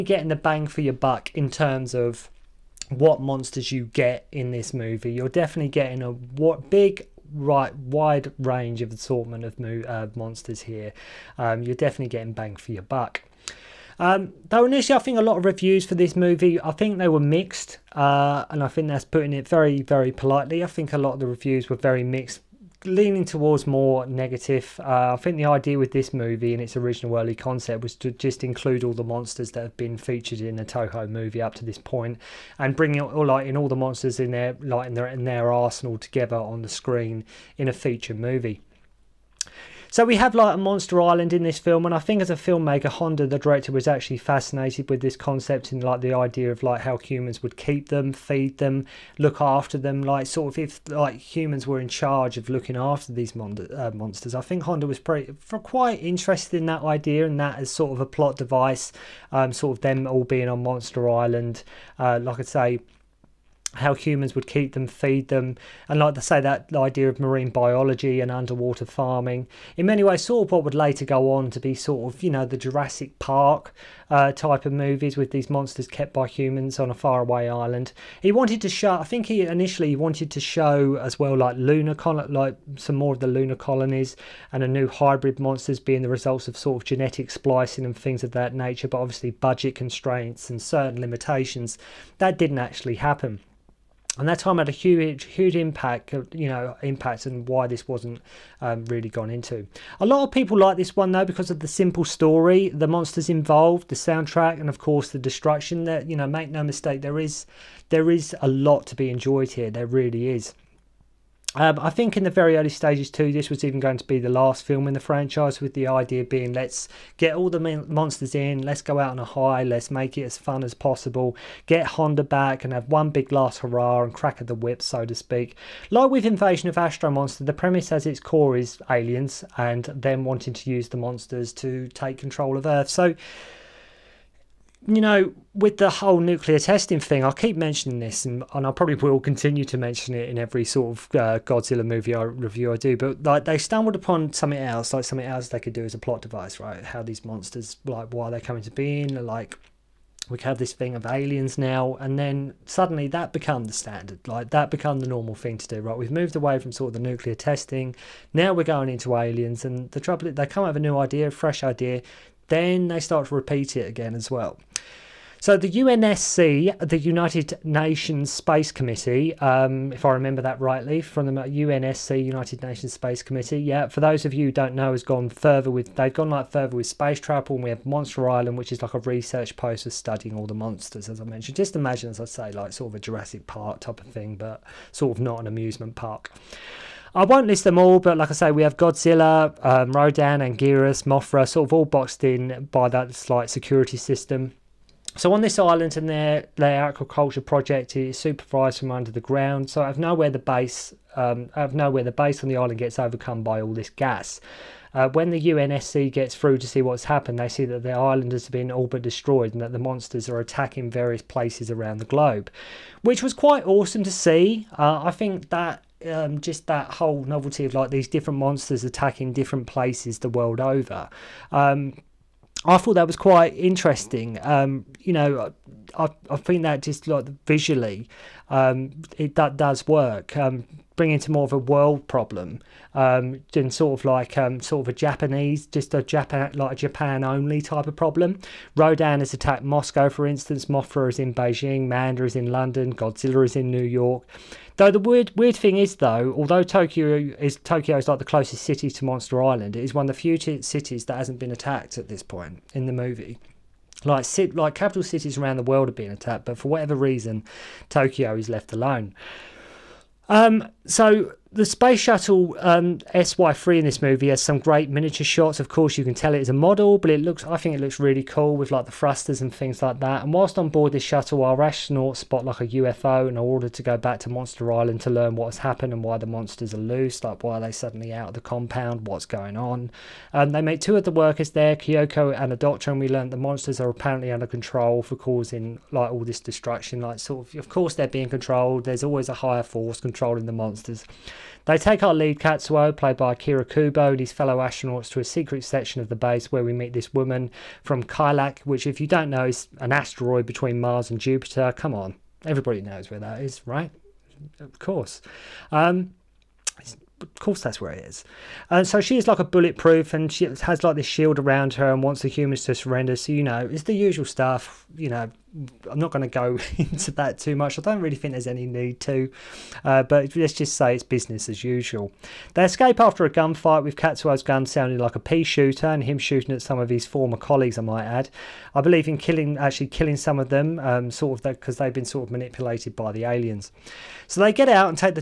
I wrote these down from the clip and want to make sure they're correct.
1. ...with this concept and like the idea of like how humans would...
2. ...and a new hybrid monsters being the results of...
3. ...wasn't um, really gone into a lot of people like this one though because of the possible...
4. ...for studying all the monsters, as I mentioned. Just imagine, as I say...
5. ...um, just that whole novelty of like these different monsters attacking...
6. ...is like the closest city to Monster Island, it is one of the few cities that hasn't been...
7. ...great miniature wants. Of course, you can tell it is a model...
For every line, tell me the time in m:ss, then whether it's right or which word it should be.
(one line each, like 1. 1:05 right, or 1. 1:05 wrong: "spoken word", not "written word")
1. 0:44 right
2. 1:24 right
3. 1:37 wrong: "simple", not "possible"
4. 2:59 right
5. 3:36 right
6. 4:07 right
7. 4:24 wrong: "shots", not "wants".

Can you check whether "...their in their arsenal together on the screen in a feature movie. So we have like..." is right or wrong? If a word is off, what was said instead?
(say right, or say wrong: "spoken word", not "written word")
right.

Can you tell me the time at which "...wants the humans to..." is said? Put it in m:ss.
5:12.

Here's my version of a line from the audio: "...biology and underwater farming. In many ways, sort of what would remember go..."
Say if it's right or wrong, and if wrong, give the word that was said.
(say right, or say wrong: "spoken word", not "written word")
wrong: "later", not "remember".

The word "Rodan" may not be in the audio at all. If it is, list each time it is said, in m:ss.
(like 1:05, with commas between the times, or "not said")
3:09, 3:58.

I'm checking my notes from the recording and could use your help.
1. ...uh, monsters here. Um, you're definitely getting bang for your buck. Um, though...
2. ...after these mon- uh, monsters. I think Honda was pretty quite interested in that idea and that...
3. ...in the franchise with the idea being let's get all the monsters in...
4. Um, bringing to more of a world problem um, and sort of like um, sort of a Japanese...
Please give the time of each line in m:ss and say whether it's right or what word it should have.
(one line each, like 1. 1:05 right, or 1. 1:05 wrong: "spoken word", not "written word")
1. 0:09 right
2. 0:52 right
3. 1:54 right
4. 3:50 right.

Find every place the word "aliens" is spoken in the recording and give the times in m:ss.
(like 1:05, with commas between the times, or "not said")
2:08, 2:31, 2:39, 5:33.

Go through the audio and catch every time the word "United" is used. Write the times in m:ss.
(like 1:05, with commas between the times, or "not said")
2:46, 2:52.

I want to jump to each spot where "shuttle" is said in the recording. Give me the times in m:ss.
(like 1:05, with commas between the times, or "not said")
4:22, 4:31.